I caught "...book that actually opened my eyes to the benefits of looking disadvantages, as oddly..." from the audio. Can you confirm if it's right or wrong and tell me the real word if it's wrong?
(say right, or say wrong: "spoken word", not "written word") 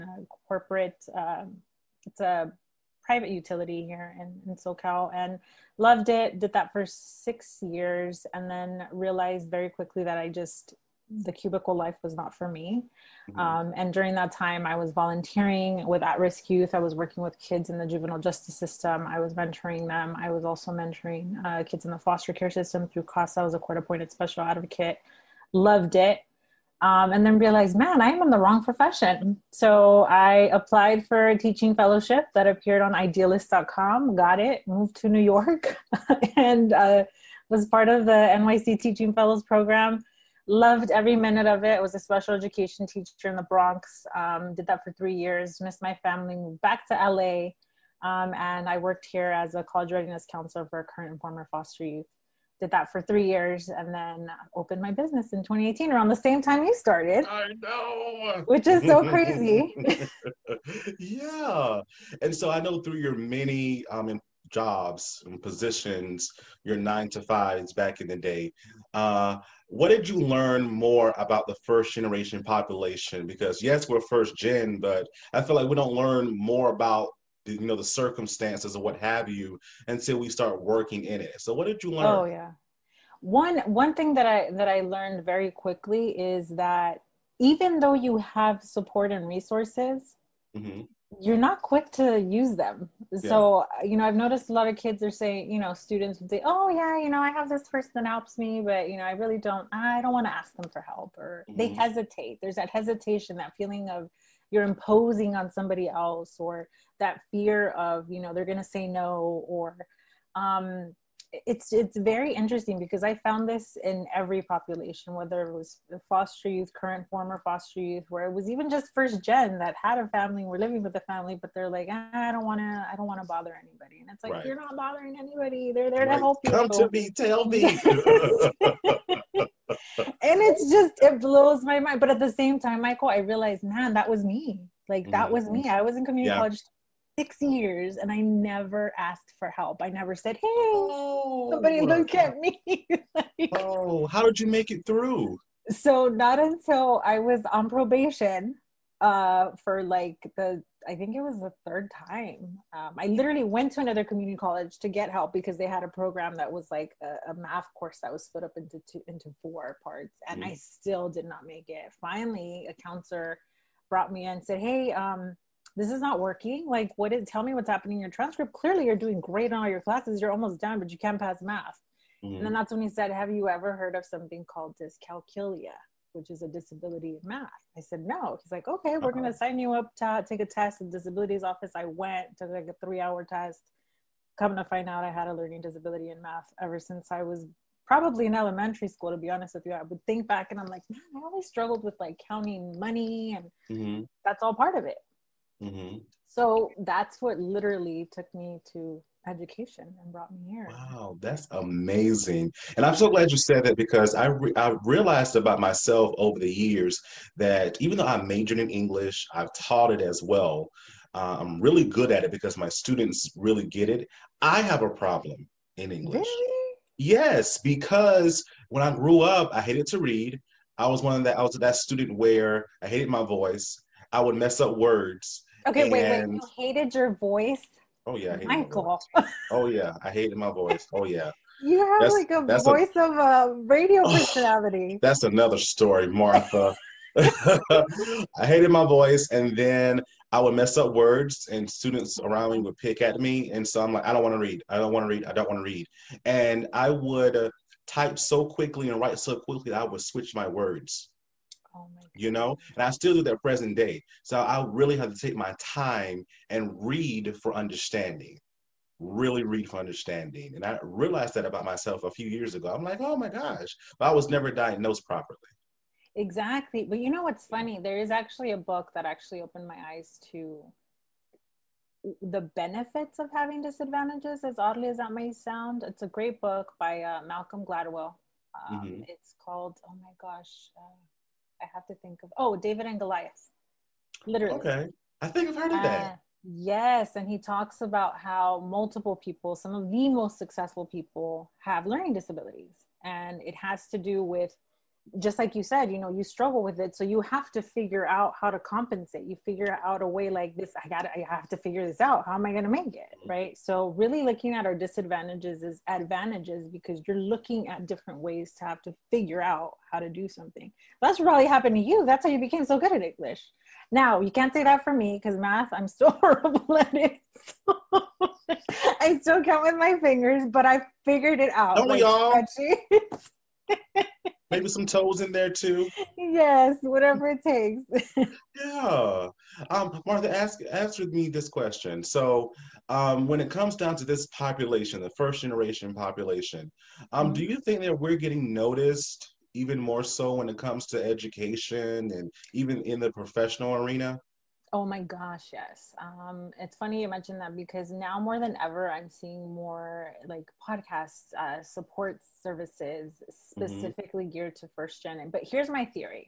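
wrong: "having", not "looking".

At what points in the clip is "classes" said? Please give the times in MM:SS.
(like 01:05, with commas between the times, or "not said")
02:49.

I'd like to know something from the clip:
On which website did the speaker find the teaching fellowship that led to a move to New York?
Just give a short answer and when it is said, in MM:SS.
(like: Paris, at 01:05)
idealist.com, at 00:32.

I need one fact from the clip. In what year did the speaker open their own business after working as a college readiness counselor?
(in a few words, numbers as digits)
2018.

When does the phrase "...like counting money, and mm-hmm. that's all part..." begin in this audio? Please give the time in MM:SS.
03:11.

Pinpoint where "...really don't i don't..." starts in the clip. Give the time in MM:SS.
01:39.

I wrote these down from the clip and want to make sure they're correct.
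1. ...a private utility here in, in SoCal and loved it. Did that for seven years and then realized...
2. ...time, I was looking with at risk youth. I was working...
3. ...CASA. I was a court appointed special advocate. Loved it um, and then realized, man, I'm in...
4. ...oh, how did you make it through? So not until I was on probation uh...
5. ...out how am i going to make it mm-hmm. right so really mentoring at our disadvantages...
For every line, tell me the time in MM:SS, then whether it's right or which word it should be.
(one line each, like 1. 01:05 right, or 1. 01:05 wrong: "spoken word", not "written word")
1. 00:02 wrong: "six", not "seven"
2. 00:14 wrong: "volunteering", not "looking"
3. 00:23 right
4. 02:23 right
5. 05:01 wrong: "looking", not "mentoring".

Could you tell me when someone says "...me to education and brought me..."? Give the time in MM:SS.
03:18.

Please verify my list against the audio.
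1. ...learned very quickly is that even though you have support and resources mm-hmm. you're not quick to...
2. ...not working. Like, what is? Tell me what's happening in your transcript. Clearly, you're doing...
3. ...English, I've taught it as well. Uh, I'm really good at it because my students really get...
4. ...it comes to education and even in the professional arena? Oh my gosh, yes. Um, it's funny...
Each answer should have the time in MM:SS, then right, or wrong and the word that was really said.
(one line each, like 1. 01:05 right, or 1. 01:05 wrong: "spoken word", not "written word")
1. 01:24 right
2. 02:46 right
3. 03:28 right
4. 05:40 right.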